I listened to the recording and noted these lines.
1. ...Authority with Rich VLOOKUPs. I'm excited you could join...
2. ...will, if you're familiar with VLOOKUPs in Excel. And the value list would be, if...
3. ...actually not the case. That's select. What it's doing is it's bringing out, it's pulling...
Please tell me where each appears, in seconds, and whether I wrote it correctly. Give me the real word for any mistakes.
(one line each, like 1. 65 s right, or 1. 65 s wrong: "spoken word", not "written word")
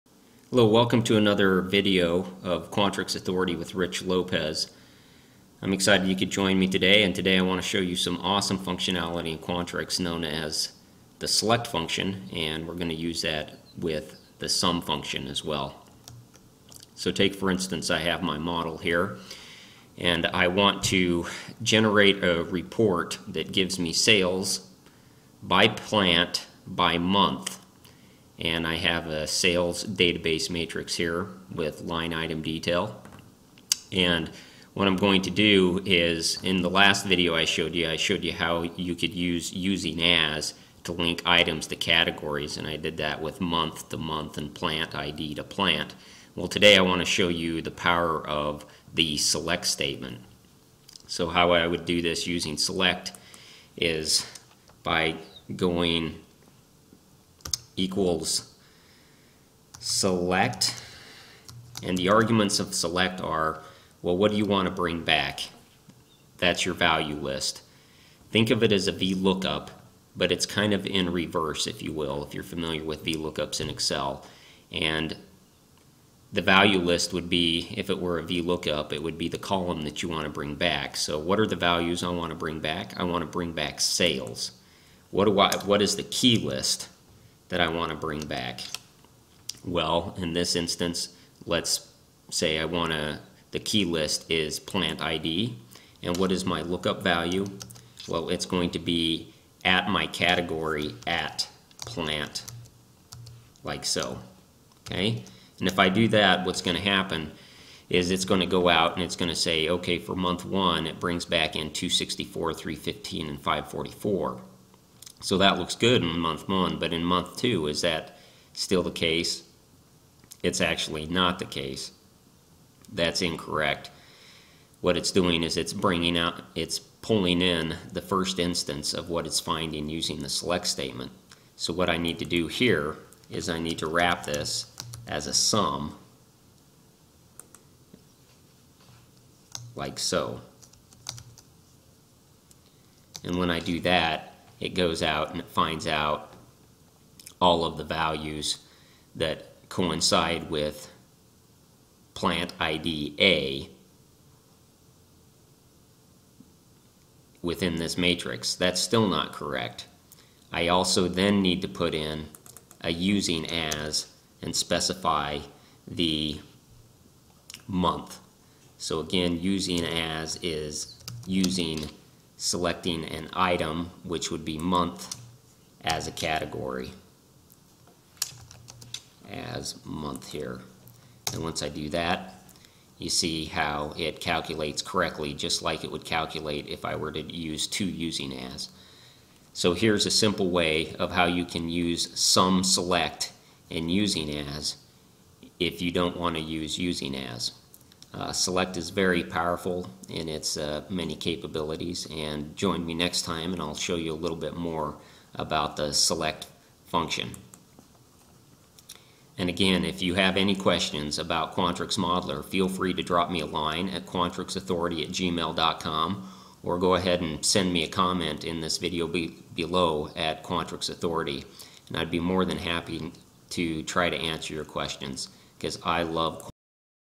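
1. 3 s wrong: "Lopez", not "VLOOKUPs"
2. 71 s right
3. 120 s wrong: "incorrect", not "select".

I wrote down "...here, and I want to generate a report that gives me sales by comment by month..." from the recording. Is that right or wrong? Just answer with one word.
wrong.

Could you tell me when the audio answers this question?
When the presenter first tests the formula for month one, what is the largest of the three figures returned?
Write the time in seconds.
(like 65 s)
113 s.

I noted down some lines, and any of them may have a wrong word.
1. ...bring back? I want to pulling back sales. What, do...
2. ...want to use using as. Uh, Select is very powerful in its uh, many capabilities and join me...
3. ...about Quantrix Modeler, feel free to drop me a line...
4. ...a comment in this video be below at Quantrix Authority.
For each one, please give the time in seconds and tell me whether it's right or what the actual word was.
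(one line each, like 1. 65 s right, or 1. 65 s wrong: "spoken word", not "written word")
1. 82 s wrong: "bring", not "pulling"
2. 196 s right
3. 211 s right
4. 217 s right.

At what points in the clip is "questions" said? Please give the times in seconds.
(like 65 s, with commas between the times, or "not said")
210 s, 224 s.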